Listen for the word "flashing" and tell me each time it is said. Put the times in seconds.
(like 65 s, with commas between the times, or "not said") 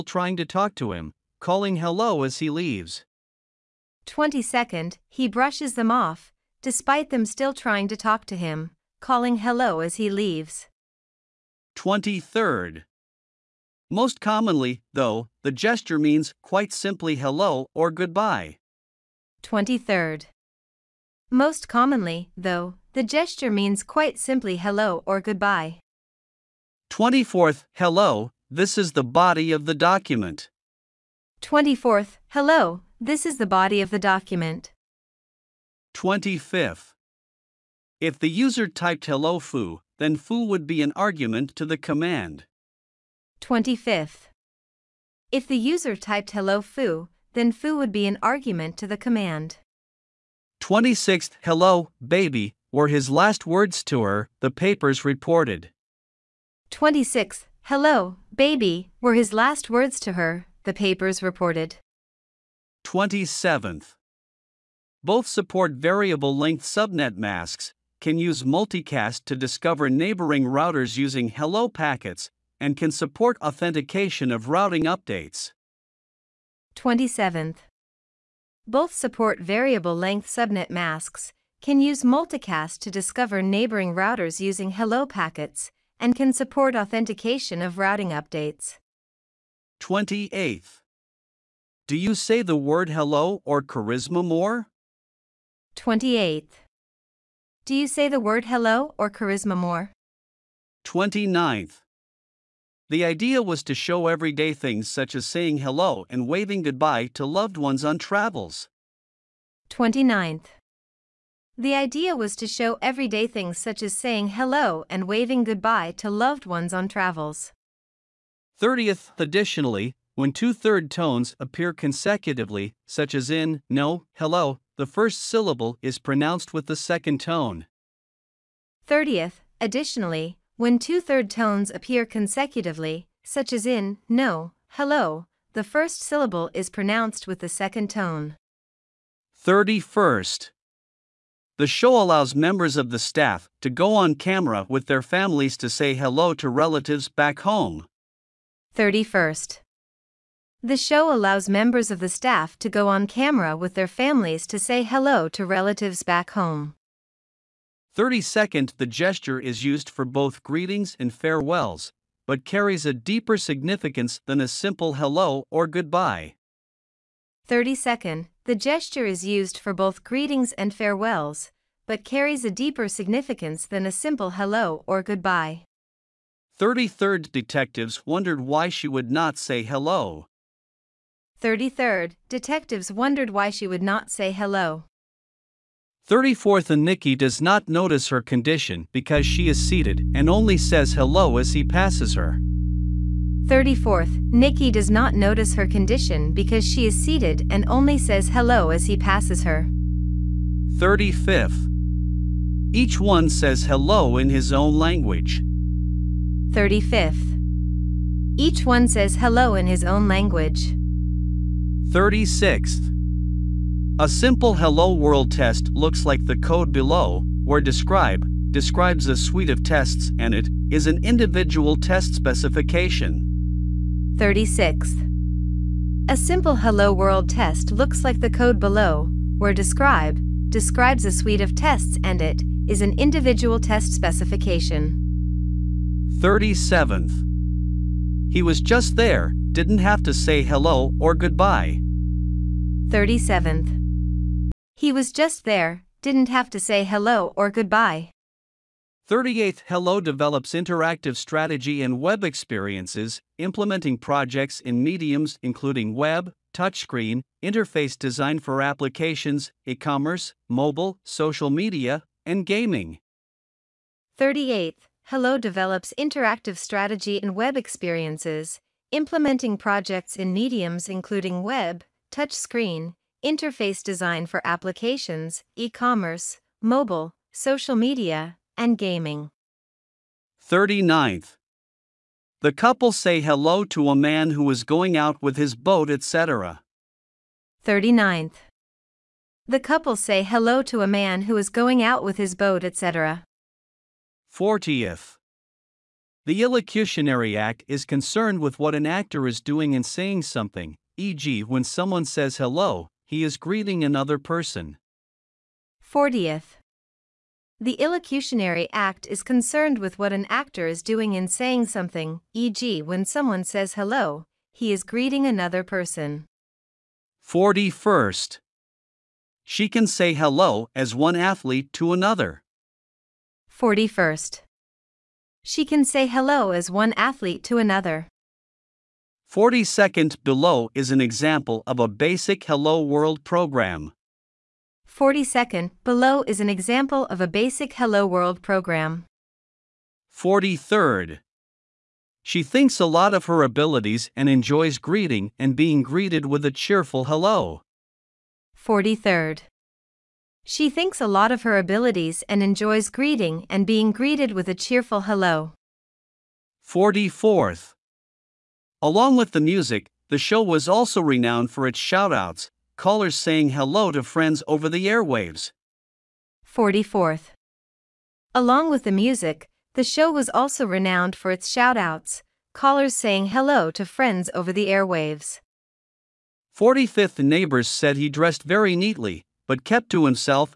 not said.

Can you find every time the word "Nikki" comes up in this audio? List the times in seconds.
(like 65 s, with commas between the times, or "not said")
186 s, 194 s.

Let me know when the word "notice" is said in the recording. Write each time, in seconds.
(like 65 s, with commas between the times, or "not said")
187 s, 195 s.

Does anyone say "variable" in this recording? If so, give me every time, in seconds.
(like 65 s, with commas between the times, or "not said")
65 s, 79 s.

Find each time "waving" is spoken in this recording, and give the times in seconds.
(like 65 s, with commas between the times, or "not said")
106 s, 115 s.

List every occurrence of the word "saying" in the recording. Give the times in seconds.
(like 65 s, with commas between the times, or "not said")
105 s, 113 s, 299 s, 311 s, 363 s, 372 s.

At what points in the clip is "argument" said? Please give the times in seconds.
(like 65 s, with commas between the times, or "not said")
40 s, 48 s.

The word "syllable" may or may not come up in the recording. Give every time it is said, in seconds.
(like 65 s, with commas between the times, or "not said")
125 s, 136 s.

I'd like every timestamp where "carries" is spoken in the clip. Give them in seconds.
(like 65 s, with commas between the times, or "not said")
162 s, 172 s.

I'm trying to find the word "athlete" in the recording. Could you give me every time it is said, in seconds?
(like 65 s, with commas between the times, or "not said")
321 s, 326 s.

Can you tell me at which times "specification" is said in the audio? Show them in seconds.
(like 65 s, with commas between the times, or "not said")
222 s, 233 s.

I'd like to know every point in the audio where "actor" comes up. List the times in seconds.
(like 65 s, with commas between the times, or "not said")
298 s, 310 s.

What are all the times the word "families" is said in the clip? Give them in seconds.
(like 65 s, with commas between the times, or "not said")
145 s, 153 s.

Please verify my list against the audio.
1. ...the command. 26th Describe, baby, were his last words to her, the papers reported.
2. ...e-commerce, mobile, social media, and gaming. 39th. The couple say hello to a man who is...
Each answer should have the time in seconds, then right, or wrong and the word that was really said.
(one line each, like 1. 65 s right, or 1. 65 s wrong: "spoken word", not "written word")
1. 48 s wrong: "Hello", not "Describe"
2. 275 s right.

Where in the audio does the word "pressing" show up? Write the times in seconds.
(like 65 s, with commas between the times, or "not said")
not said.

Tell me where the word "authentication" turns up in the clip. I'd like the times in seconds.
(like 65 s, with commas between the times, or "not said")
73 s, 86 s.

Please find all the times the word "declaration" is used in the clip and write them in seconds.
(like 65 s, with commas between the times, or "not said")
not said.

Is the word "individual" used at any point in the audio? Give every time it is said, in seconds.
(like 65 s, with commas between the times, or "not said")
221 s, 232 s.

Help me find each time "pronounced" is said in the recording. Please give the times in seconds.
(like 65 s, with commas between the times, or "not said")
125 s, 136 s.